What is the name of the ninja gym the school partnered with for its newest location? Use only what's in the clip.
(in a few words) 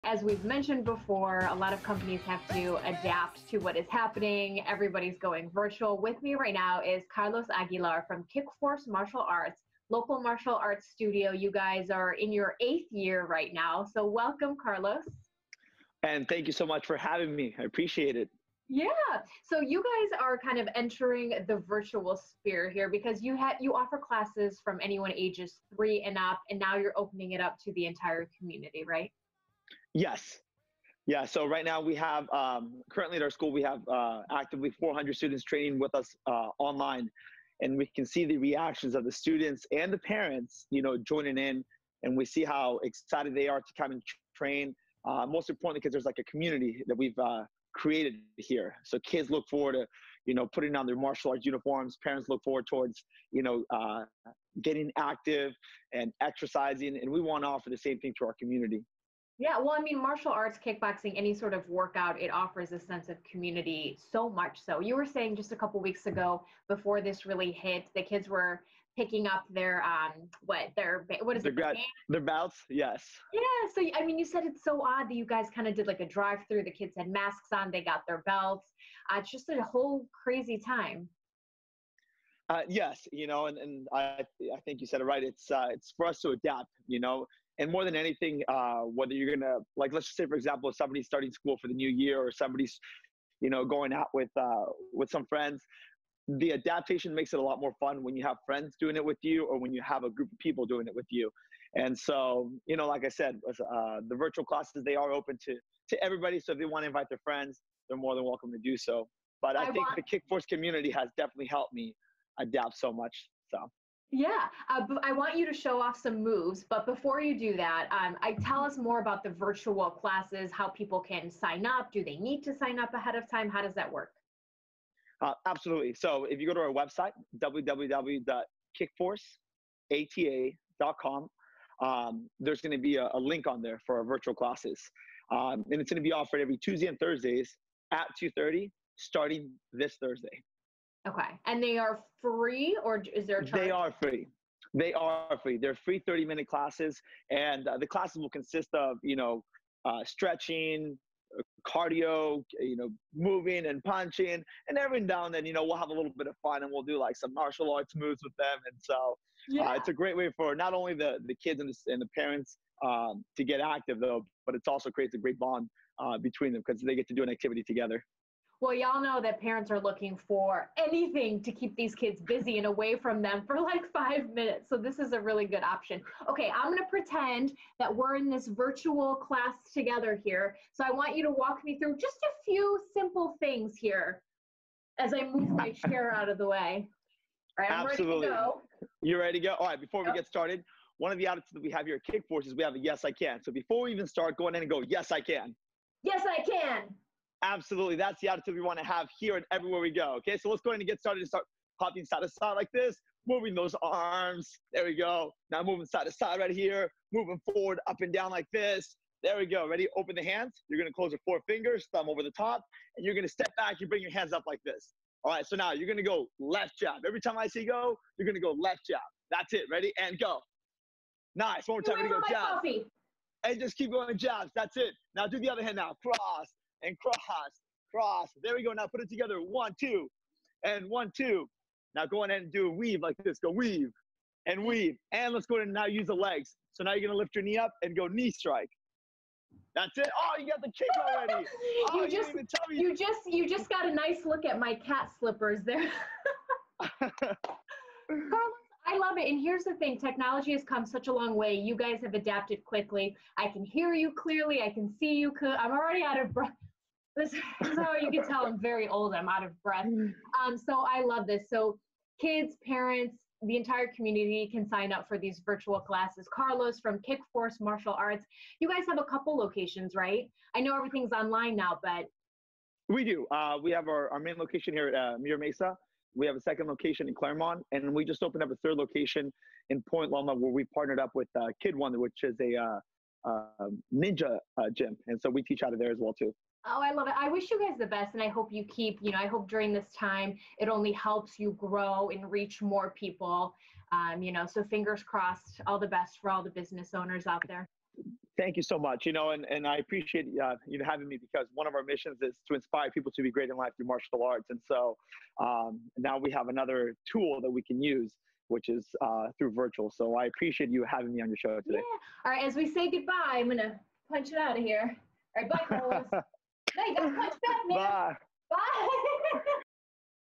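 Kid One.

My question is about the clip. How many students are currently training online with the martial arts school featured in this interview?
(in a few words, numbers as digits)
400.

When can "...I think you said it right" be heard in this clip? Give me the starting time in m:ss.
1:24.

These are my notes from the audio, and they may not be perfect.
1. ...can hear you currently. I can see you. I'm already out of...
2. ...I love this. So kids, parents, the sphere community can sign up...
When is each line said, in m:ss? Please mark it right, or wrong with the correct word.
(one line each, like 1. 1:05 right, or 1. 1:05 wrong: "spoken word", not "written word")
1. 4:13 wrong: "clearly", not "currently"
2. 4:20 wrong: "entire", not "sphere".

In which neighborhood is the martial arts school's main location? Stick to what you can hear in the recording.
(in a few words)
Mira Mesa.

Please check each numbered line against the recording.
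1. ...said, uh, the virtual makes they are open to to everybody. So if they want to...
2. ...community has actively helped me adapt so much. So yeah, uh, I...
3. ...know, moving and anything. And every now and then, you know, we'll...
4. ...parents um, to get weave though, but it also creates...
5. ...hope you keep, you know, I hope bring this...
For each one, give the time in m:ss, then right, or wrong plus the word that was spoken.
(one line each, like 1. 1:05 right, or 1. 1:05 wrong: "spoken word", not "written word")
1. 1:43 wrong: "classes", not "makes"
2. 1:50 wrong: "definitely", not "actively"
3. 2:32 wrong: "punching", not "anything"
4. 2:42 wrong: "active", not "weave"
5. 4:48 wrong: "during", not "bring".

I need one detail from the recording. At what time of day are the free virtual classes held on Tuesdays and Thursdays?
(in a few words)
2:30.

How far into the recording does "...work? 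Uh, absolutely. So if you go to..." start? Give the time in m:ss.
2:03.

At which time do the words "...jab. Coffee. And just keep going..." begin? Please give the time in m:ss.
3:42.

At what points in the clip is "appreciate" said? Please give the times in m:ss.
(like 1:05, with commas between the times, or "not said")
0:17, 4:59, 5:10.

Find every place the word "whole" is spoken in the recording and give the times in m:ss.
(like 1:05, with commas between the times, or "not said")
1:19.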